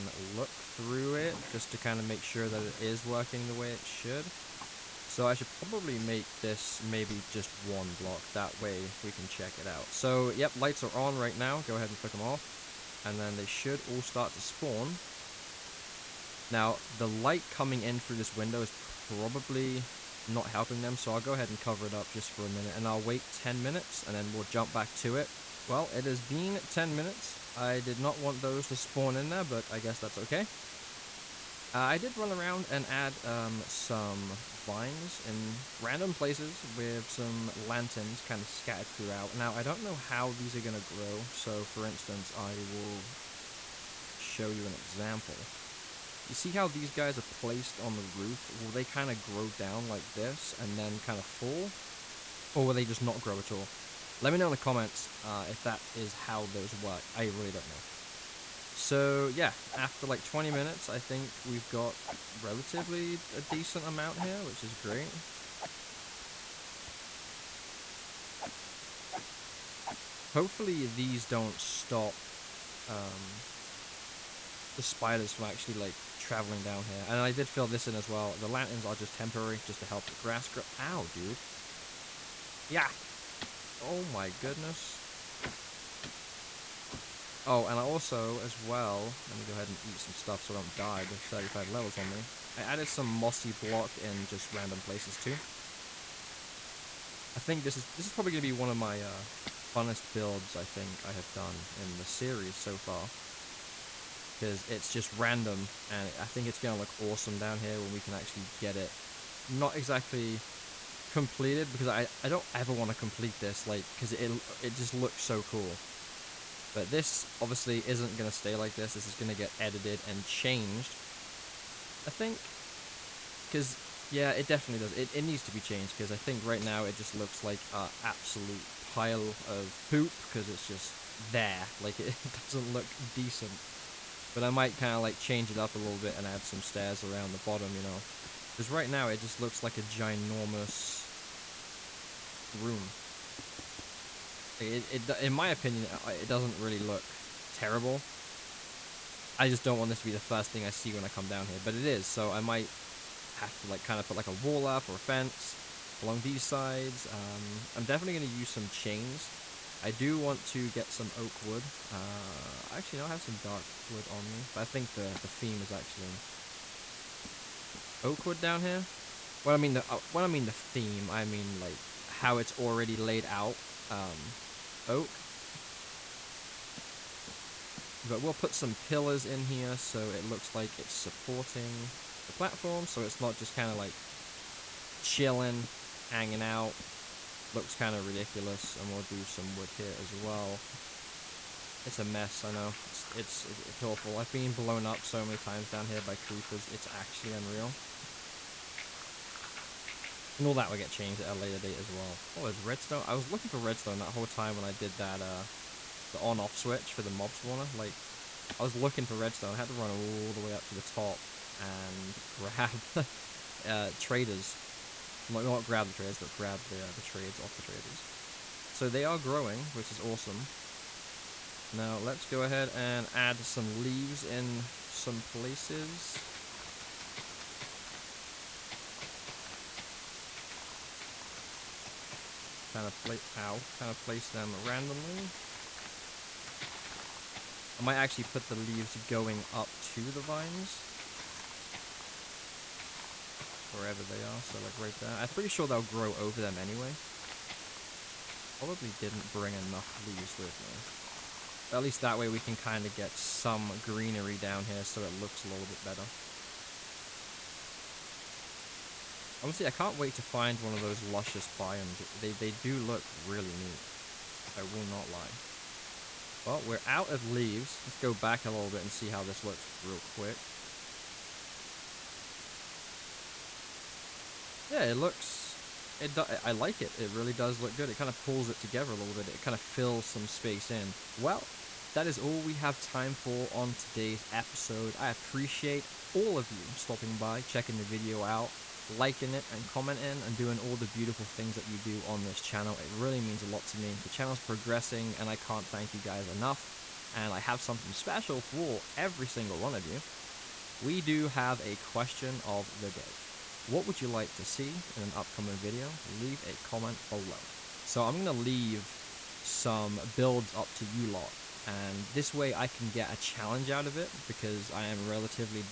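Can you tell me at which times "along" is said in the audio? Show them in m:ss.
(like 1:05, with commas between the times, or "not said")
2:36.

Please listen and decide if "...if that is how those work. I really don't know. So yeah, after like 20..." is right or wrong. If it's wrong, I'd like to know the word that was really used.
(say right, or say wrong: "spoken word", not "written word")
right.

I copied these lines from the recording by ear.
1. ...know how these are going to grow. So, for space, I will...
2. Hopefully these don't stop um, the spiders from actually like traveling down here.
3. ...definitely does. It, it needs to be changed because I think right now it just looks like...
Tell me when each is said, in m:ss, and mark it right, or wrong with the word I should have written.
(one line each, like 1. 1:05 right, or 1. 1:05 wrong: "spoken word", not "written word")
1. 0:39 wrong: "instance", not "space"
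2. 1:10 right
3. 2:04 right.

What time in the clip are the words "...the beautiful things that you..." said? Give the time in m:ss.
4:50.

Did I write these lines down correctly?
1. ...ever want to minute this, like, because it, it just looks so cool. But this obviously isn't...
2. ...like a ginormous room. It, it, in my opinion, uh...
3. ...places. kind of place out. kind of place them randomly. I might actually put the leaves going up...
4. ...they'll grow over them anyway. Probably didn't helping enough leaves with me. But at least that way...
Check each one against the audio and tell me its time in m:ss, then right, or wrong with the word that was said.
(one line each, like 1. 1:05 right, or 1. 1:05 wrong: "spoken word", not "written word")
1. 1:52 wrong: "complete", not "minute"
2. 2:19 right
3. 3:45 right
4. 4:05 wrong: "bring", not "helping".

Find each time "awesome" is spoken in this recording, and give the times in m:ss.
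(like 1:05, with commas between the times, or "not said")
1:46, 3:40.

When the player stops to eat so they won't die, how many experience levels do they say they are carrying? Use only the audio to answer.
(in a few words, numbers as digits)
35.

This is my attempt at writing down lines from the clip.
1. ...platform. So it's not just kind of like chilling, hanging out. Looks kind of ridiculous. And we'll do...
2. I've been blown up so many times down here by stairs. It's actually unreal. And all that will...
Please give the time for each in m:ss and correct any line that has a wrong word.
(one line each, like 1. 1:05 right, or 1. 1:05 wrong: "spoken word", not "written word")
1. 3:02 right
2. 3:14 wrong: "creepers", not "stairs".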